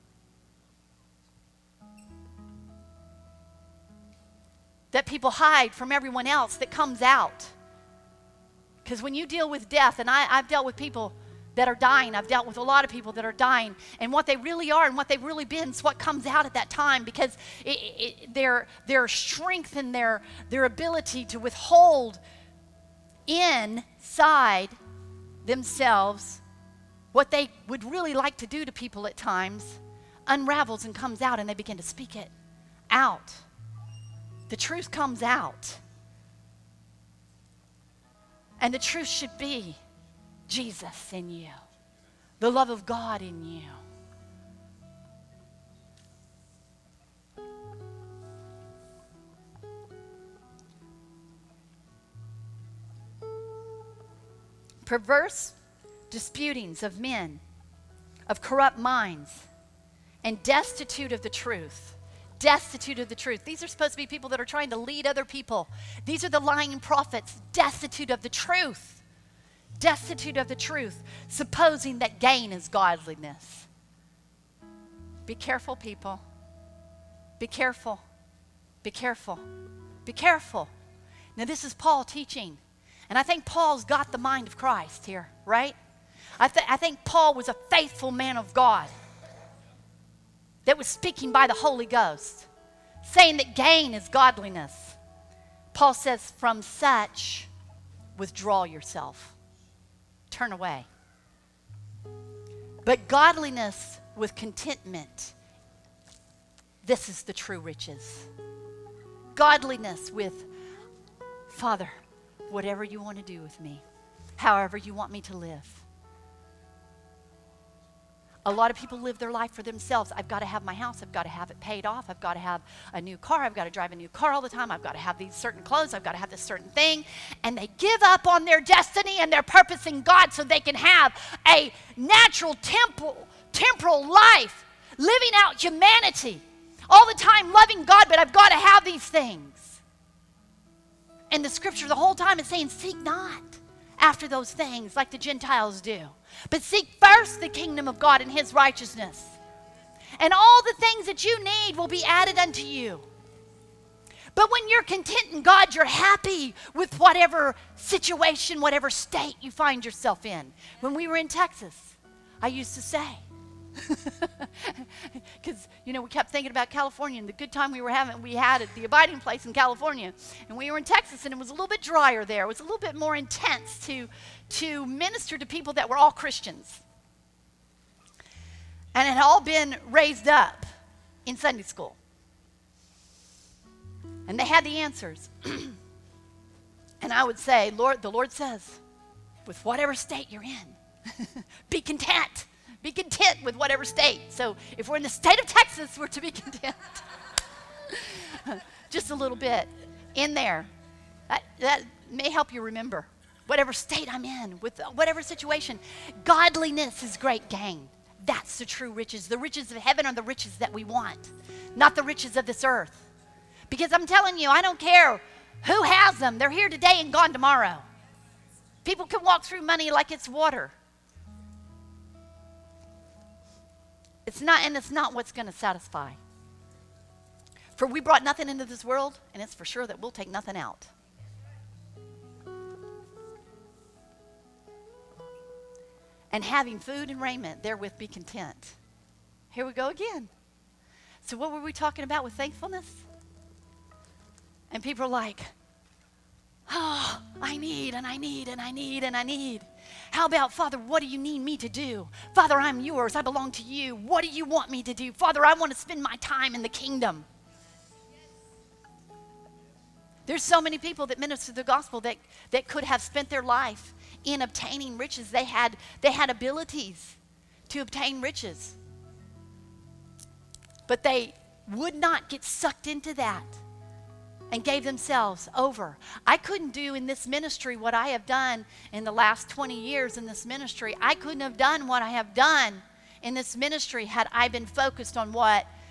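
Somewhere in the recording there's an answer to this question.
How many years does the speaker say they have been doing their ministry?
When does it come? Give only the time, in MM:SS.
04:39.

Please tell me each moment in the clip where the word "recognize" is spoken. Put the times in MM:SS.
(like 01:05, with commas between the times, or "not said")
not said.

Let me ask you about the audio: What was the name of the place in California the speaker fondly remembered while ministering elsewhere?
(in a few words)
the abiding place.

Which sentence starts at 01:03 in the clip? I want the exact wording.
These are supposed to be people that are trying to lead other people.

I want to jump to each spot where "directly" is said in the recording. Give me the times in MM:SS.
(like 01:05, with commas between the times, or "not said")
not said.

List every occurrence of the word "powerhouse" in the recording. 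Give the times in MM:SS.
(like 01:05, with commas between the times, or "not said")
not said.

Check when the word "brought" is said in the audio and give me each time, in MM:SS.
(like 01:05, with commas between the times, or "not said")
03:48.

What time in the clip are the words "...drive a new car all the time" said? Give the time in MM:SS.
02:03.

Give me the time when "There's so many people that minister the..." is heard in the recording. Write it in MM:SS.
04:20.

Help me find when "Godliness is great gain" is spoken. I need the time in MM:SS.
03:26.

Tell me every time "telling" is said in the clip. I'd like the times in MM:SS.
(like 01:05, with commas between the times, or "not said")
03:34.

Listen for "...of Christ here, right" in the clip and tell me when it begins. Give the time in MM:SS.
01:24.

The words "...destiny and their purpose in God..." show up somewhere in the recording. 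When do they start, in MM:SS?
02:08.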